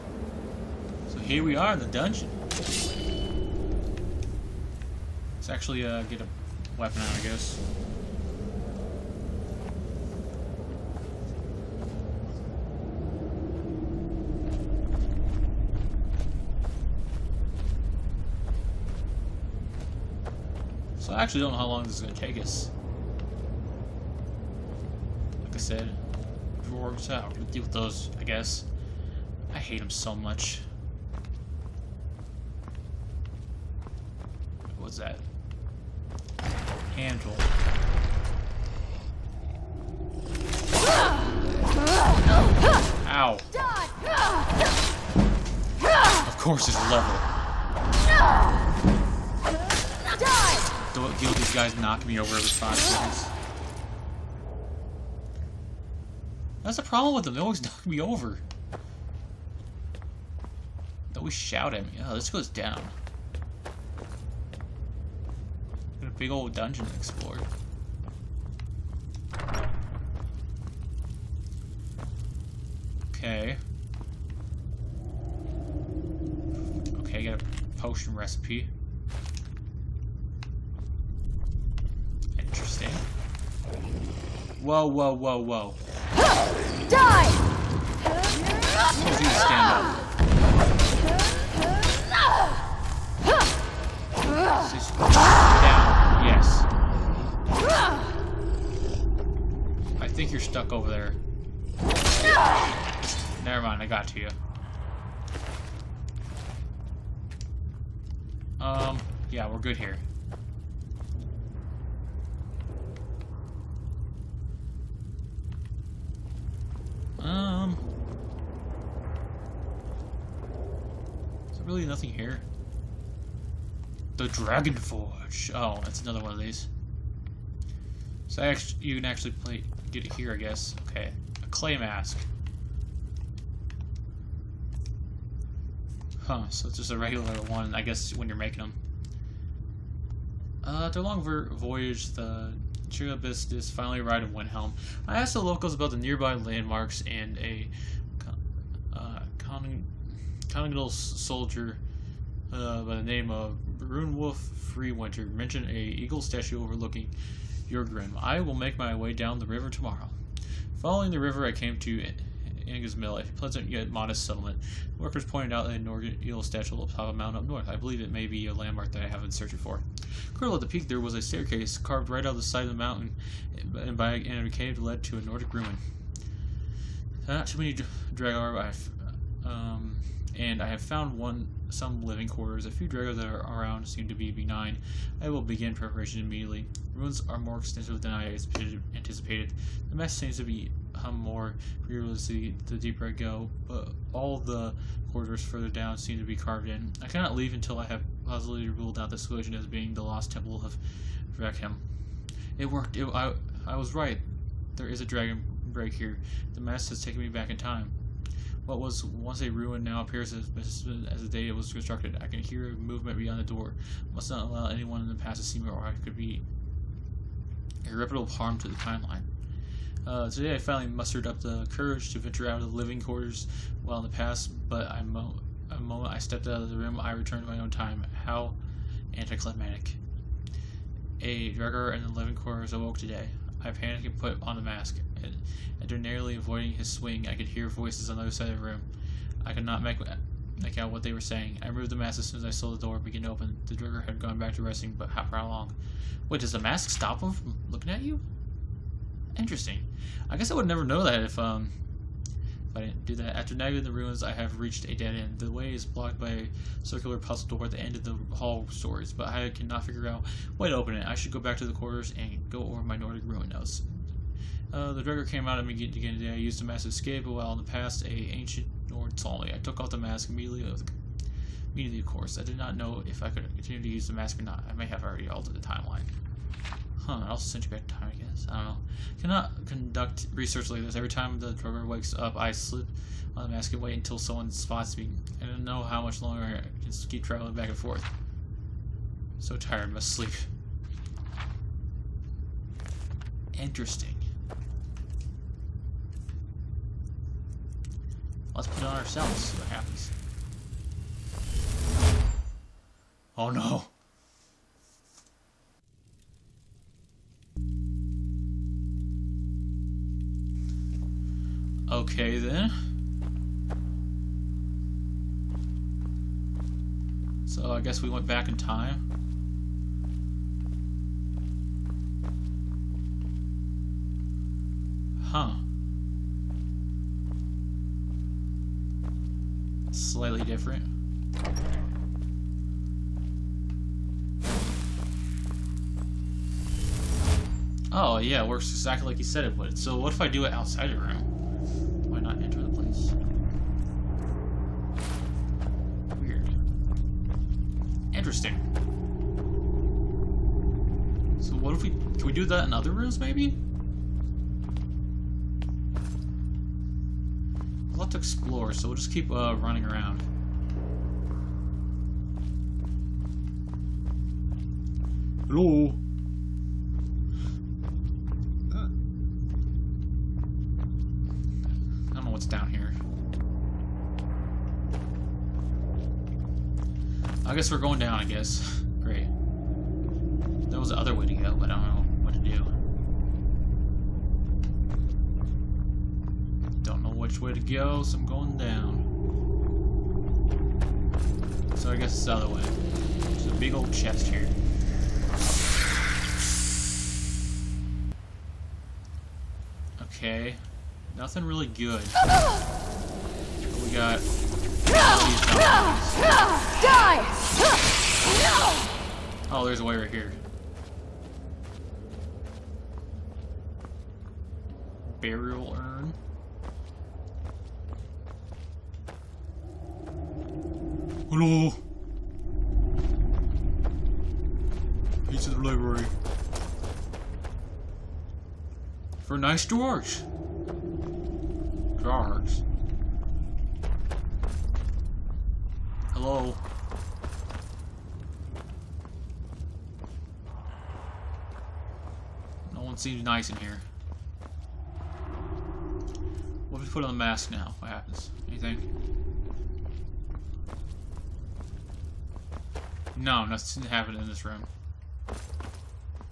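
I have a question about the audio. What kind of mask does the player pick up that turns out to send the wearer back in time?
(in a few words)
Clay mask.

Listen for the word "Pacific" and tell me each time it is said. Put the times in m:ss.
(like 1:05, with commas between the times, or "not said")
not said.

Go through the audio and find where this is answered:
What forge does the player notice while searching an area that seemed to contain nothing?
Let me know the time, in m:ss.
2:04.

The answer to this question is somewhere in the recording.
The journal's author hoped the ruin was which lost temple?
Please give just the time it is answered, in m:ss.
3:21.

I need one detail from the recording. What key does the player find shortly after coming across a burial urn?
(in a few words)
Key to the library.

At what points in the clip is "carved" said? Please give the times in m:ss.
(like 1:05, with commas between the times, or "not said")
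2:51, 3:16.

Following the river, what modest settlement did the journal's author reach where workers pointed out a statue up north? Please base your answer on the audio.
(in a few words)
Anga's Mill.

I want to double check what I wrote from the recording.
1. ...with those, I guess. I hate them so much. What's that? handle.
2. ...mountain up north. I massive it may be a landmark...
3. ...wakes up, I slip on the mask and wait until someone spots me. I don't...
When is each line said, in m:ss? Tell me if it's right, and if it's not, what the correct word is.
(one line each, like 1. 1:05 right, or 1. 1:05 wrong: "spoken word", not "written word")
1. 0:27 right
2. 2:47 wrong: "believe", not "massive"
3. 4:41 right.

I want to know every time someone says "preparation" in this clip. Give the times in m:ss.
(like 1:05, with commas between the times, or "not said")
3:05.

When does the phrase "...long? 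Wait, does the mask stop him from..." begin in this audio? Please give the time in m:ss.
4:05.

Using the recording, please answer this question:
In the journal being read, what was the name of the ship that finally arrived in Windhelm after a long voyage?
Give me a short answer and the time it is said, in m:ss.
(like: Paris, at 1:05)
Chiribistis, at 2:22.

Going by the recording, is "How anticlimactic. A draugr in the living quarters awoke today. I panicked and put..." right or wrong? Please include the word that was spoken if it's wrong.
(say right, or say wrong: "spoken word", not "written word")
right.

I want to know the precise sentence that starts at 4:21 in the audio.
I should go back to the quarters and go over my Nordic ruin notes.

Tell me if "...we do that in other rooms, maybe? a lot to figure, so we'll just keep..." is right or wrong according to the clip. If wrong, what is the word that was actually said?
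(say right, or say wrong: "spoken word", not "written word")
wrong: "explore", not "figure".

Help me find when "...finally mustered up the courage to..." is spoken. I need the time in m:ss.
3:40.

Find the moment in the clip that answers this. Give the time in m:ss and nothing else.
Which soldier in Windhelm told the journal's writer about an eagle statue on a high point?
2:33.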